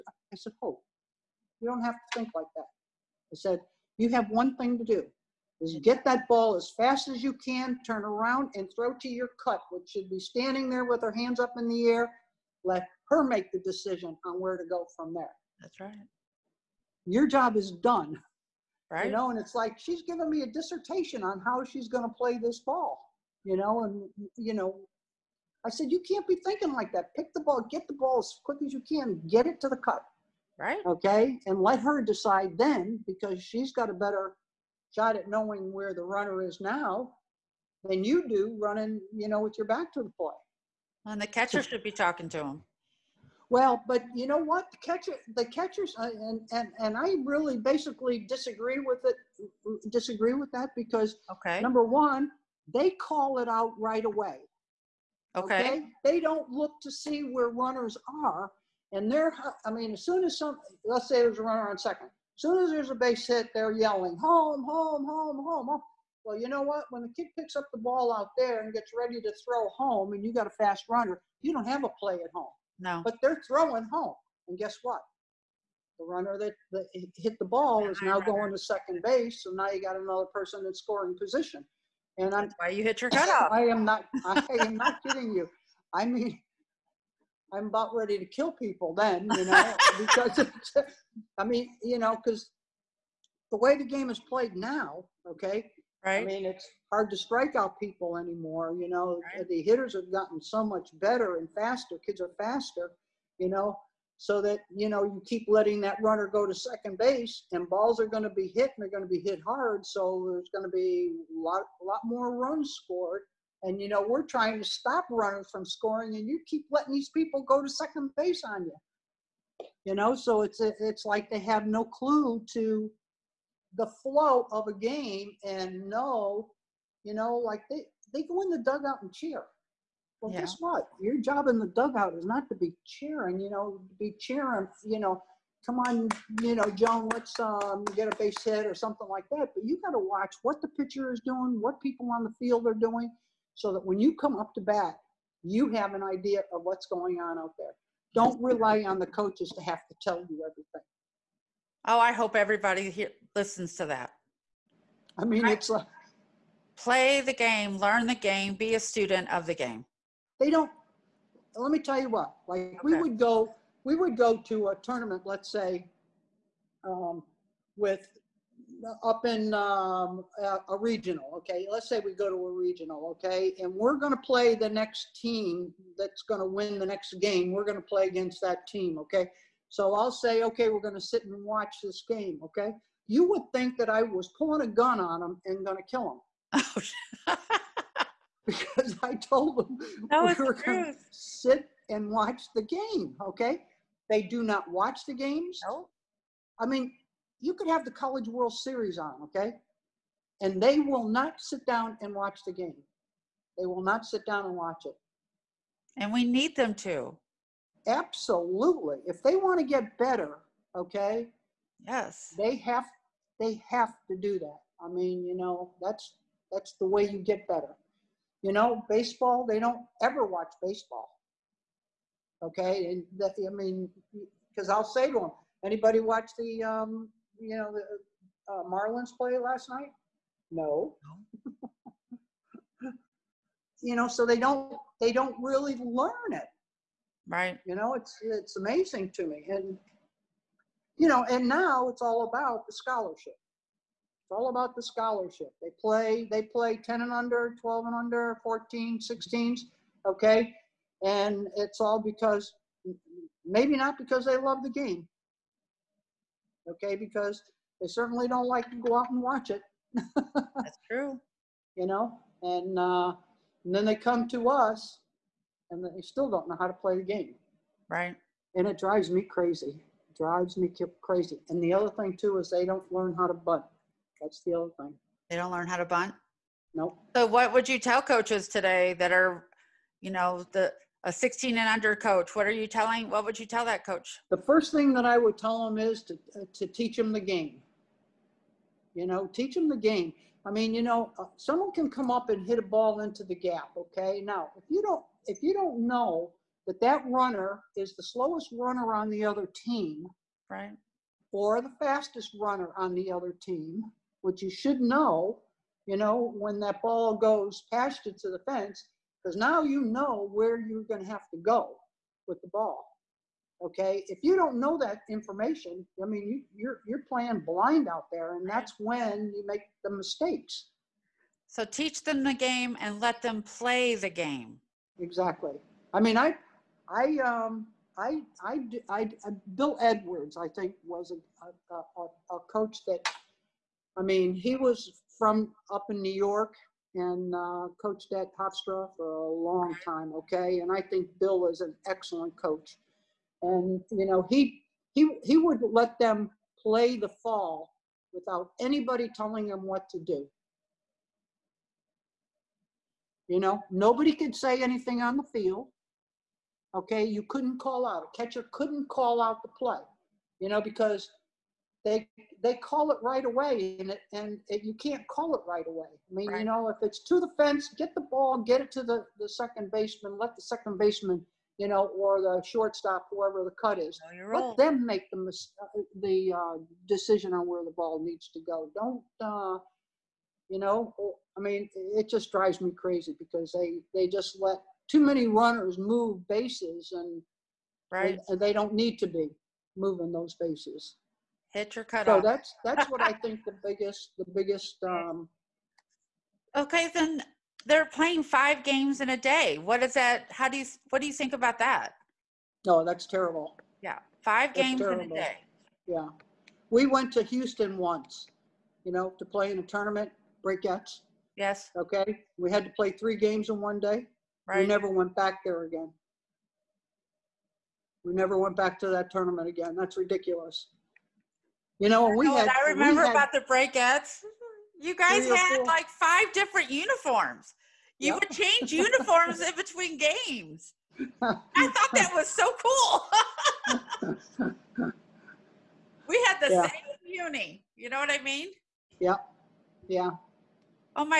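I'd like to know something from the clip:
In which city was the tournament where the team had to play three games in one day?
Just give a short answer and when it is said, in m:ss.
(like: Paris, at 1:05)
Houston, at 6:47.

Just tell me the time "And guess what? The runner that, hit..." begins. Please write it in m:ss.
1:14.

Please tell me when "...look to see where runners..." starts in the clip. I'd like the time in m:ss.
0:56.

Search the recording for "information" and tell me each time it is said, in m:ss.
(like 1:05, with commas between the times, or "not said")
5:15.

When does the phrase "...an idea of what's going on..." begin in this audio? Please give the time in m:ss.
2:25.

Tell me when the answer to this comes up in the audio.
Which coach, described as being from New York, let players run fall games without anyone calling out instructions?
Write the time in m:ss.
5:29.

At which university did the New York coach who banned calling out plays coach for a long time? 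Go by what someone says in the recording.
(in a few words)
Hofstra.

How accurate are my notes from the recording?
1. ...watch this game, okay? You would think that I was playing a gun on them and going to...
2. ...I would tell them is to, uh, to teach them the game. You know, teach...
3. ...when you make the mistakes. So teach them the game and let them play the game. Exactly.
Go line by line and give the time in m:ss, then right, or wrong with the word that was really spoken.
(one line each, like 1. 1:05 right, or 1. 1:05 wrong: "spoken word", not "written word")
1. 3:01 wrong: "pulling", not "playing"
2. 4:45 right
3. 5:18 right.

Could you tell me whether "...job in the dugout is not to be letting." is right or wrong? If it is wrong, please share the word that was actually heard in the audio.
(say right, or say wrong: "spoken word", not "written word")
wrong: "cheering", not "letting".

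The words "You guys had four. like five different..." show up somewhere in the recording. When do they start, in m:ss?
7:04.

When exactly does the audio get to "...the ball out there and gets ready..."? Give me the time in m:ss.
1:07.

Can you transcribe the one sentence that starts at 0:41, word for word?
And the catcher should be talking to him.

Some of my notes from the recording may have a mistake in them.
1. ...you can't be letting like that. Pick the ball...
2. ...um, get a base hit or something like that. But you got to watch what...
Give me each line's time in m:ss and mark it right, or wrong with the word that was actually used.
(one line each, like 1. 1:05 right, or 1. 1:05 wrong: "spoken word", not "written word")
1. 0:25 wrong: "thinking", not "letting"
2. 2:17 right.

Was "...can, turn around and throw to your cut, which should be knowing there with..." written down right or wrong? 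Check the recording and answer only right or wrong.
wrong.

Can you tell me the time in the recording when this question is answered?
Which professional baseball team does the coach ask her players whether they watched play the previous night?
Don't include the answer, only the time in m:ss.
3:48.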